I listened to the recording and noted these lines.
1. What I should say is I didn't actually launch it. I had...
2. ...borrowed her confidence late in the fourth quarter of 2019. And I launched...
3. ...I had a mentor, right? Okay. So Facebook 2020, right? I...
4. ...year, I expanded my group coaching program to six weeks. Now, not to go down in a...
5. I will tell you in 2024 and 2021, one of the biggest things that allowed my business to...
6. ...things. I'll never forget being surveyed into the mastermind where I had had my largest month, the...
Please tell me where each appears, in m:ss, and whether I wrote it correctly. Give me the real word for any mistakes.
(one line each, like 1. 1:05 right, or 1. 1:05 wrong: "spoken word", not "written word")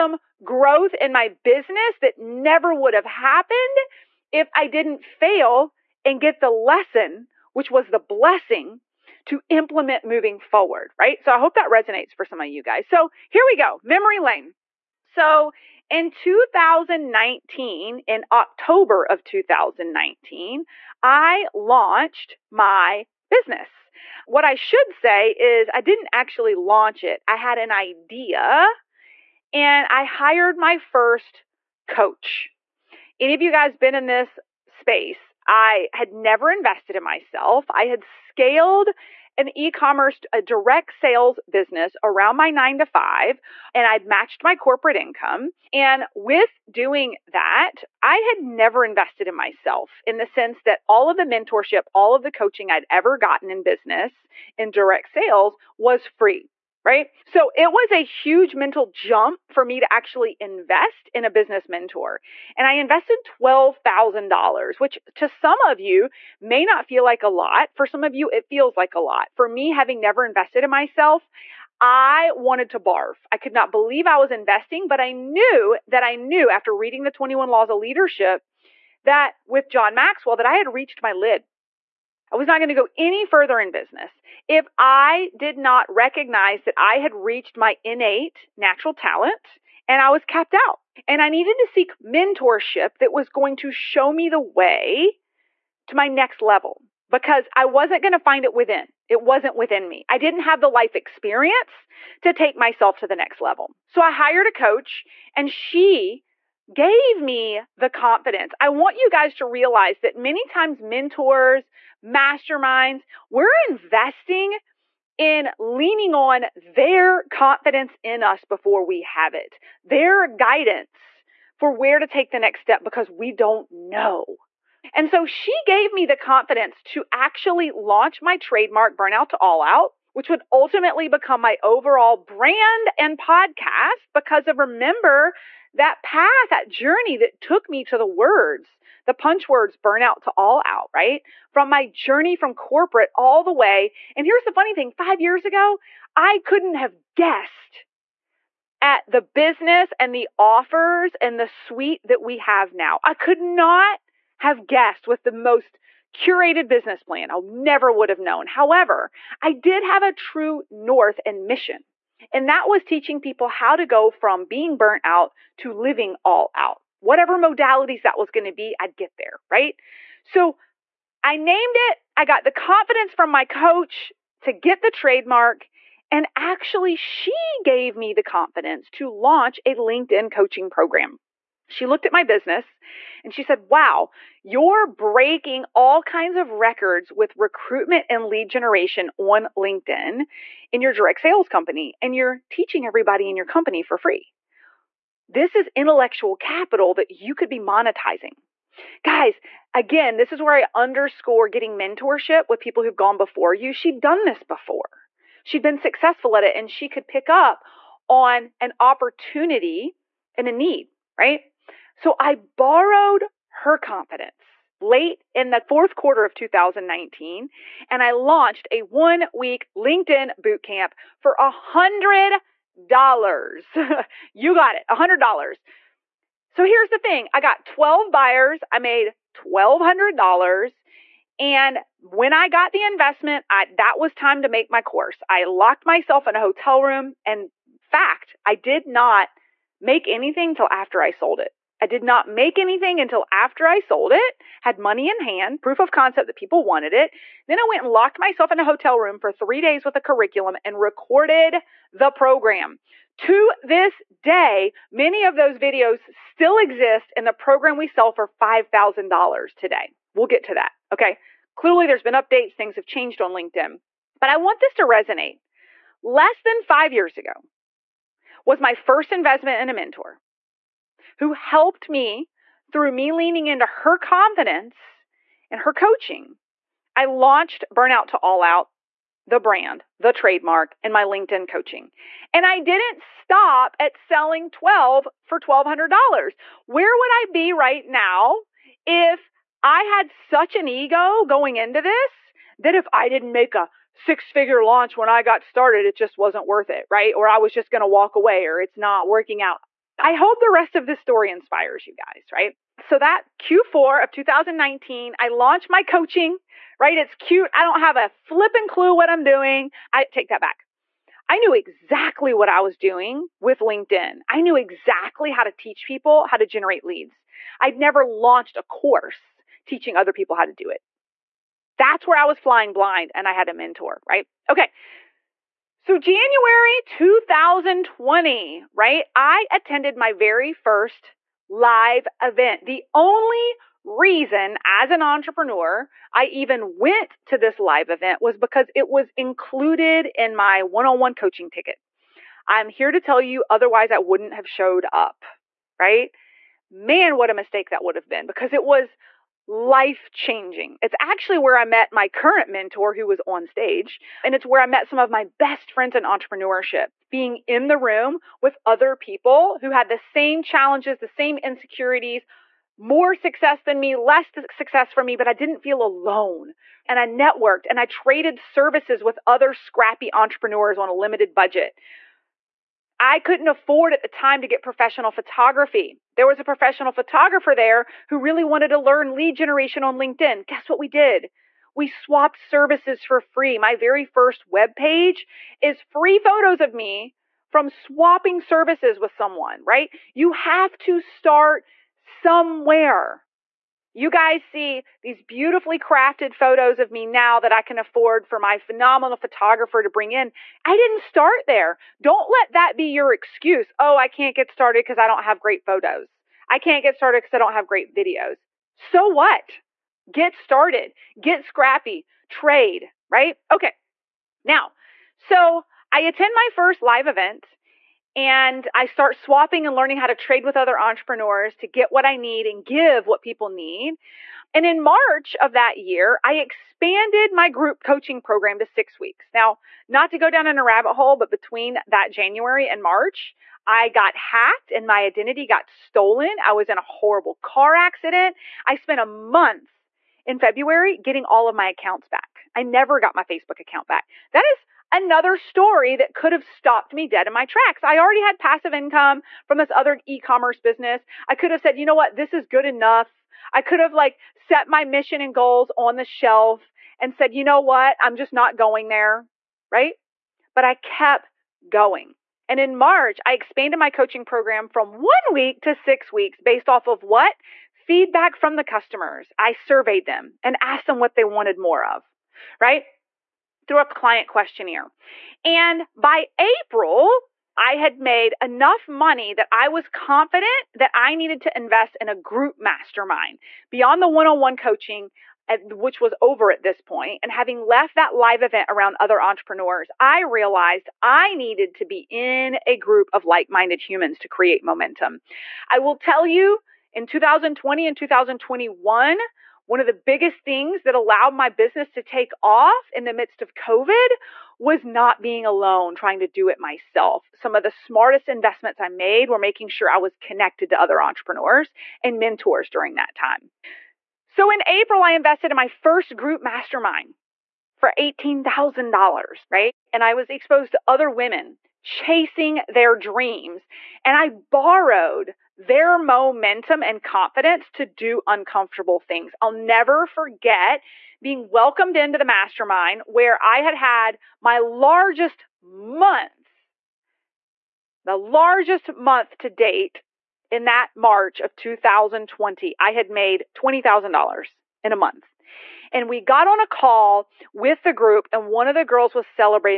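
1. 0:24 right
2. 3:32 right
3. 5:23 wrong: "January", not "Facebook"
4. 7:05 right
5. 8:15 wrong: "2020", not "2024"
6. 8:48 wrong: "welcomed", not "surveyed".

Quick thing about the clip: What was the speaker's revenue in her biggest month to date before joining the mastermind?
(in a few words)
$20,000.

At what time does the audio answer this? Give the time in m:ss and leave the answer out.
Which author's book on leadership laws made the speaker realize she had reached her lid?
1:19.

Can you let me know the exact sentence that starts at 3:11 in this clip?
And you're teaching everybody in your company for free.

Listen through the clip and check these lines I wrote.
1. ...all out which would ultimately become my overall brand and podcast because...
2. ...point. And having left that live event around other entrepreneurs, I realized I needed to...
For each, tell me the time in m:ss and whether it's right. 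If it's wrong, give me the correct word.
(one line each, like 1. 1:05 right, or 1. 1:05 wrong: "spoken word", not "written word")
1. 2:09 right
2. 8:06 right.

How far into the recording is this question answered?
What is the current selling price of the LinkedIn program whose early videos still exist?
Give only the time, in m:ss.
4:18.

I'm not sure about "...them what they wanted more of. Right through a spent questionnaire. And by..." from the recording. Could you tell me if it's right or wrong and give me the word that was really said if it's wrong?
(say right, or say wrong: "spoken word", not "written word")
wrong: "client", not "spent".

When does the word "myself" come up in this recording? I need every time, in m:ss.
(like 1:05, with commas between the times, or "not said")
0:37, 0:49, 1:10, 1:42, 3:55, 4:08, 8:26.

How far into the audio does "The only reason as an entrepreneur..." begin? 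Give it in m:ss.
5:32.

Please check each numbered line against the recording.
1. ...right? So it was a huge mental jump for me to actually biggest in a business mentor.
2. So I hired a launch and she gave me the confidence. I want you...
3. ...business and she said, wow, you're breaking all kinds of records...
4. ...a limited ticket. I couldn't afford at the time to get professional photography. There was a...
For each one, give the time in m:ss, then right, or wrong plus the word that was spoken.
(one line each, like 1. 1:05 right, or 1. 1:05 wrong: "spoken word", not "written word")
1. 0:56 wrong: "invest", not "biggest"
2. 1:43 wrong: "coach", not "launch"
3. 3:02 right
4. 6:10 wrong: "budget", not "ticket".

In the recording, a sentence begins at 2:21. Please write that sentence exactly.
From my journey from corporate all the way.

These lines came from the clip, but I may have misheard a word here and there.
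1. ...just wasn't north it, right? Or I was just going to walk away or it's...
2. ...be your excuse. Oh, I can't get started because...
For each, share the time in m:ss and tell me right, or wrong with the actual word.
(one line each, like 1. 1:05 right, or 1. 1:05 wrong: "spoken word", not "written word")
1. 4:55 wrong: "worth", not "north"
2. 6:42 right.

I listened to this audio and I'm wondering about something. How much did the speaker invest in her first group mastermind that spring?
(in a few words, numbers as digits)
$18,000.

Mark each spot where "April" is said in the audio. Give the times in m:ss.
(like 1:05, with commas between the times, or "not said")
7:56, 8:34.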